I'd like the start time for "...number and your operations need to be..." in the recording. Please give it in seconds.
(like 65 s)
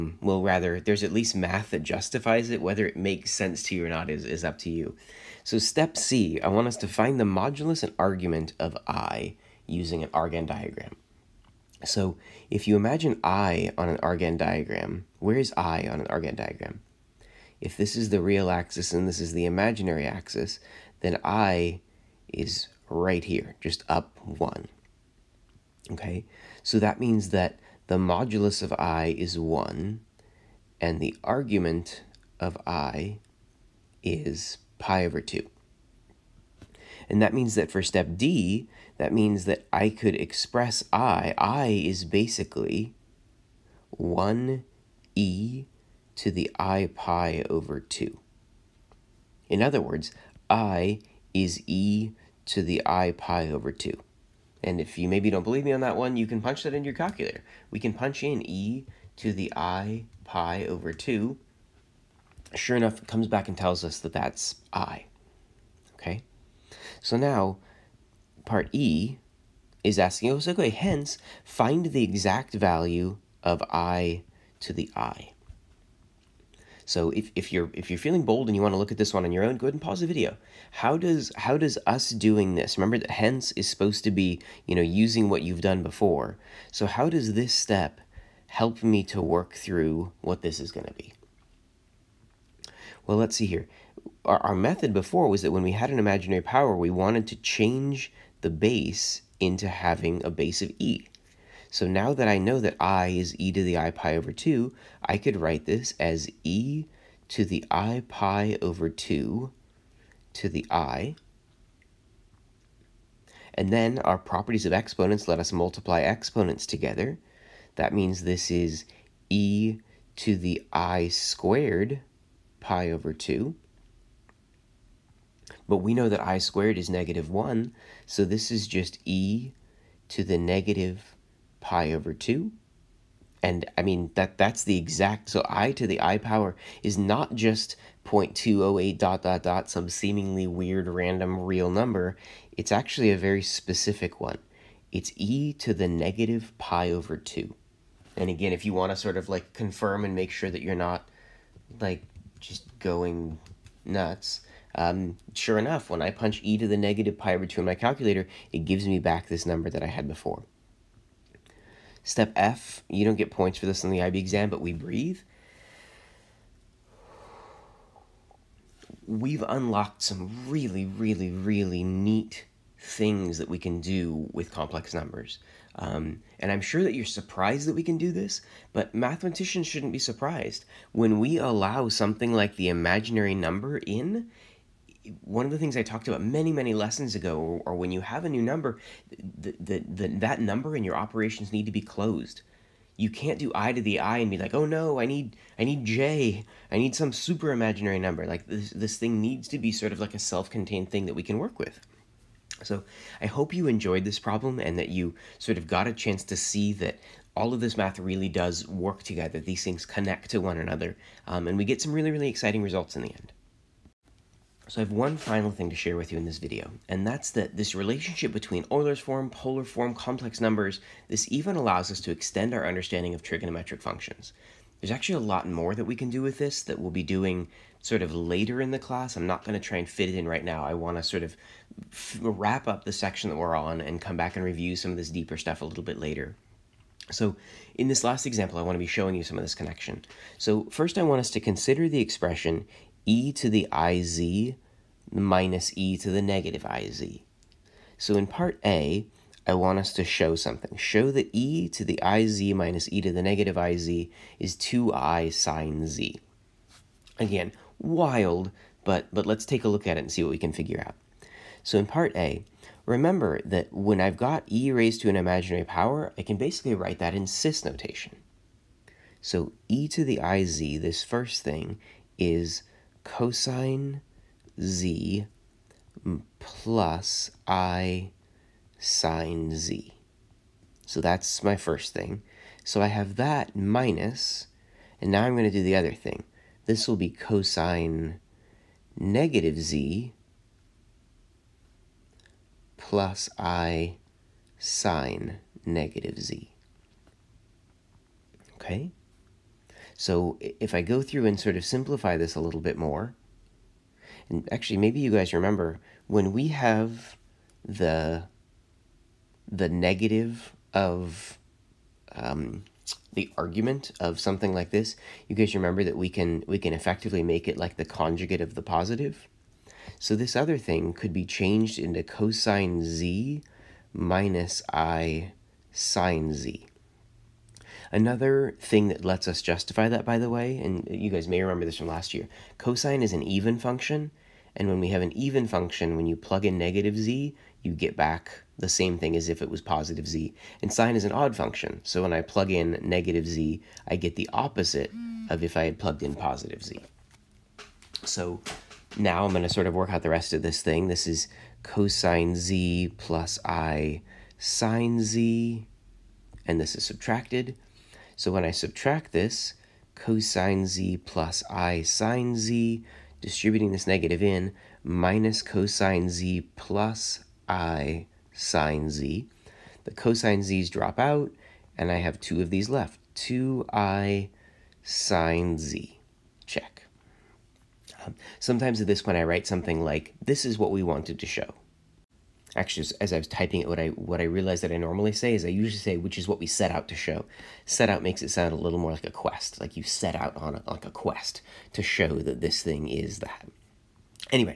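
190 s.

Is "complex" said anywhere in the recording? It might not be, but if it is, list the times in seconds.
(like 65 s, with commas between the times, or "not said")
174 s, 219 s.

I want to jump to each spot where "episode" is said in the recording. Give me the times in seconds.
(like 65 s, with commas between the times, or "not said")
not said.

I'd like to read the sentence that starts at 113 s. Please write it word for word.
And then our properties of exponents let us multiply exponents together.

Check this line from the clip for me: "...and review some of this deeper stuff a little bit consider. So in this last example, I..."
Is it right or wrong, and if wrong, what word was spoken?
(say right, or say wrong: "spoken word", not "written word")
wrong: "later", not "consider".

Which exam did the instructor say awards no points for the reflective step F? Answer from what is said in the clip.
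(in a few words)
IB exam.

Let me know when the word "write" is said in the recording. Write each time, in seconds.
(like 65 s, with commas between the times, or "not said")
105 s, 266 s, 379 s.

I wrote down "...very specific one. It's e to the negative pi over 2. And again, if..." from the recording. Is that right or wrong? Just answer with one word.
right.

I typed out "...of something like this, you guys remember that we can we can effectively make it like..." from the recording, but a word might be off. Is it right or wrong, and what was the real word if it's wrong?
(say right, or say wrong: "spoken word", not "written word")
right.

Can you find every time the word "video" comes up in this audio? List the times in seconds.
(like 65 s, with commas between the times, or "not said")
80 s, 216 s.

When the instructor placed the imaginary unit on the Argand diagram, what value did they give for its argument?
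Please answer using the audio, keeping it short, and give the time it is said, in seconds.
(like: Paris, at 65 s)
pi over 2, at 34 s.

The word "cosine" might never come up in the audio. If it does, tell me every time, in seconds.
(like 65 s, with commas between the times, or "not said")
273 s, 287 s, 322 s, 332 s, 351 s, 359 s, 365 s, 369 s.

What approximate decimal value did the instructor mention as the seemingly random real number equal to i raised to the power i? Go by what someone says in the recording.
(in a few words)
0.208...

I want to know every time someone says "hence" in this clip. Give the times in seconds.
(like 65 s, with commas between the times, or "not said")
70 s, 83 s.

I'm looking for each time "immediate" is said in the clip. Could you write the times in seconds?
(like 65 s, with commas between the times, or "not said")
not said.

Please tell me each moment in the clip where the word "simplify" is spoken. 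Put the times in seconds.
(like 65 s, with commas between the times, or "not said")
301 s.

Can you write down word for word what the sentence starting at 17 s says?
If this is the real axis and this is the imaginary axis, then I is right here, just up one.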